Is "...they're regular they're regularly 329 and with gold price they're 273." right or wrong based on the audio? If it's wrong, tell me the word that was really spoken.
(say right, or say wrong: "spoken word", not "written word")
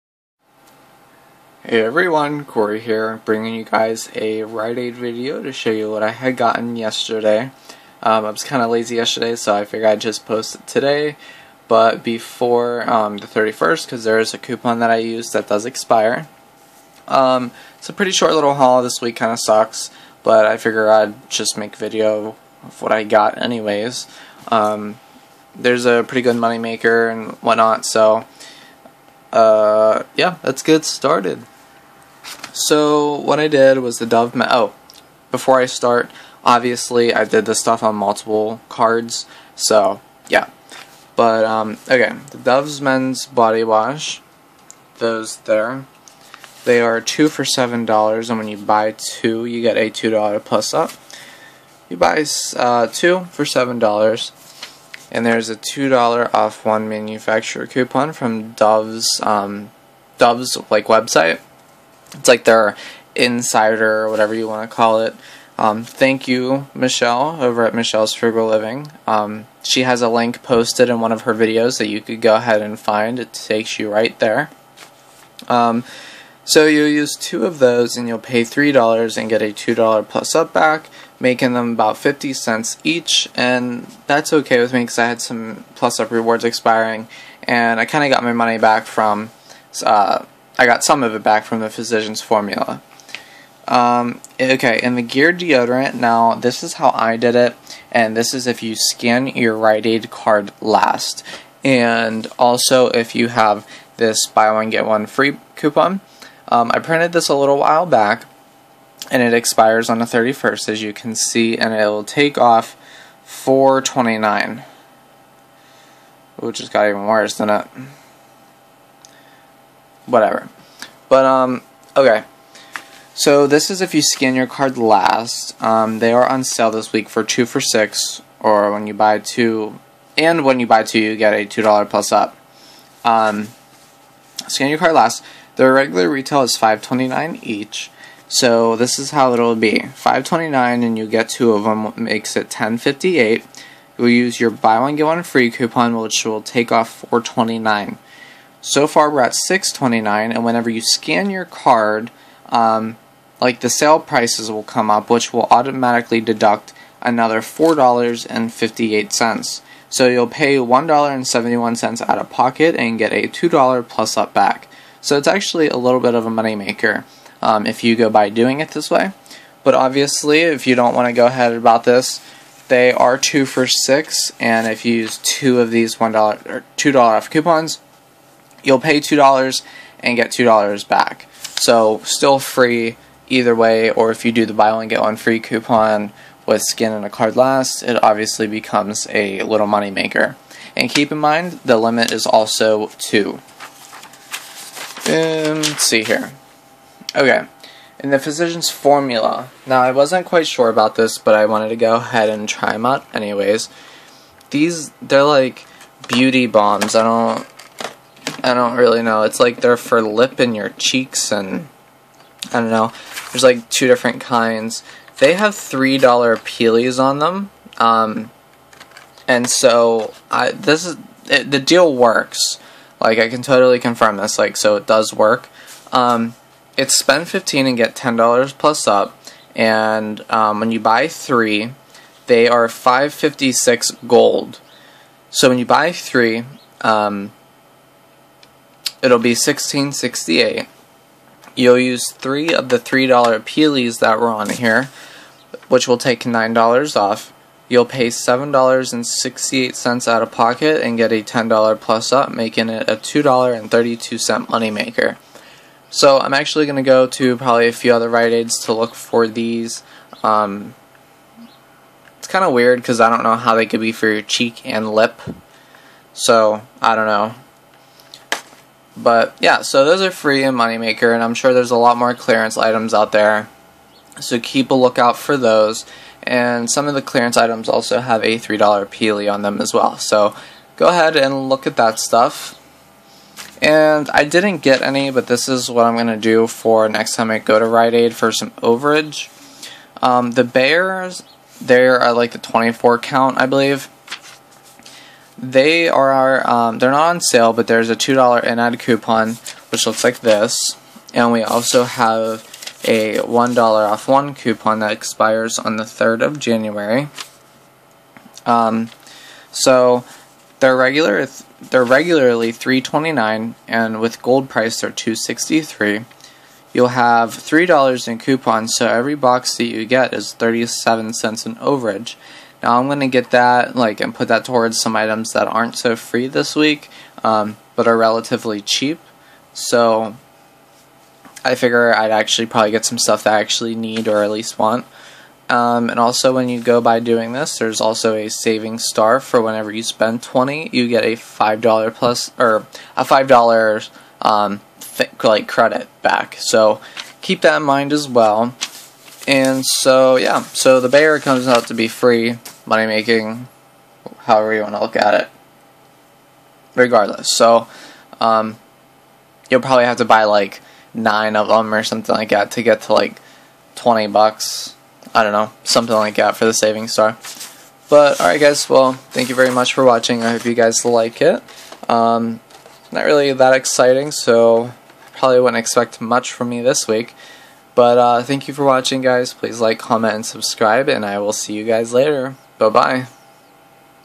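wrong: "263", not "273".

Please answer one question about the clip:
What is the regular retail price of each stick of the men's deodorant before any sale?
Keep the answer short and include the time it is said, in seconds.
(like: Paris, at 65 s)
$5.29, at 136 s.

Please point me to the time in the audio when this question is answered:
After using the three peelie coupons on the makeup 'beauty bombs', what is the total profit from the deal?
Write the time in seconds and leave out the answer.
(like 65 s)
252 s.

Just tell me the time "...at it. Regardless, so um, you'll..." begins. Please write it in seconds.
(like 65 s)
354 s.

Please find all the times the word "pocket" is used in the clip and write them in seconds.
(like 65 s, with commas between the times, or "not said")
162 s, 250 s.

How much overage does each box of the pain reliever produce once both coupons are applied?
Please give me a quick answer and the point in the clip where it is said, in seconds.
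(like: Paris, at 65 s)
37 cents, at 320 s.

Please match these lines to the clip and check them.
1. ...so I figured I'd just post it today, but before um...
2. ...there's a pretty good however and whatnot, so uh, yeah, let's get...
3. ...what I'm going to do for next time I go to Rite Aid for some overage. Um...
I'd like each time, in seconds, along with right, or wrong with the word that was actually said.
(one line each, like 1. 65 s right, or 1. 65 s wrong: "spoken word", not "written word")
1. 9 s right
2. 25 s wrong: "moneymaker", not "however"
3. 285 s right.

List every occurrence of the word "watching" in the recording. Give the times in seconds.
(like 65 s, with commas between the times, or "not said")
369 s, 378 s.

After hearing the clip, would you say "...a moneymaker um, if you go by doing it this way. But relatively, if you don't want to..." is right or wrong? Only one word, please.
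wrong.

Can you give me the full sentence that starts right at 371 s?
Um, not really that exciting, so probably wouldn't expect much from me this week.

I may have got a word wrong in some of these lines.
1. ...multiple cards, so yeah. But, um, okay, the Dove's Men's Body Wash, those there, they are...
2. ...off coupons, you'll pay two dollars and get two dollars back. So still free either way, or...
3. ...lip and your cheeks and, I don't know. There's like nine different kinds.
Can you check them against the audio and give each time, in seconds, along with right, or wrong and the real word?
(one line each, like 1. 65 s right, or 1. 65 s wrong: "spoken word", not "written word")
1. 37 s right
2. 177 s right
3. 210 s wrong: "two", not "nine".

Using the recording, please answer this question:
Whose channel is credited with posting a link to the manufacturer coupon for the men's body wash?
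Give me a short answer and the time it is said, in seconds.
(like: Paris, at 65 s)
Michelle's Frugal Living, at 67 s.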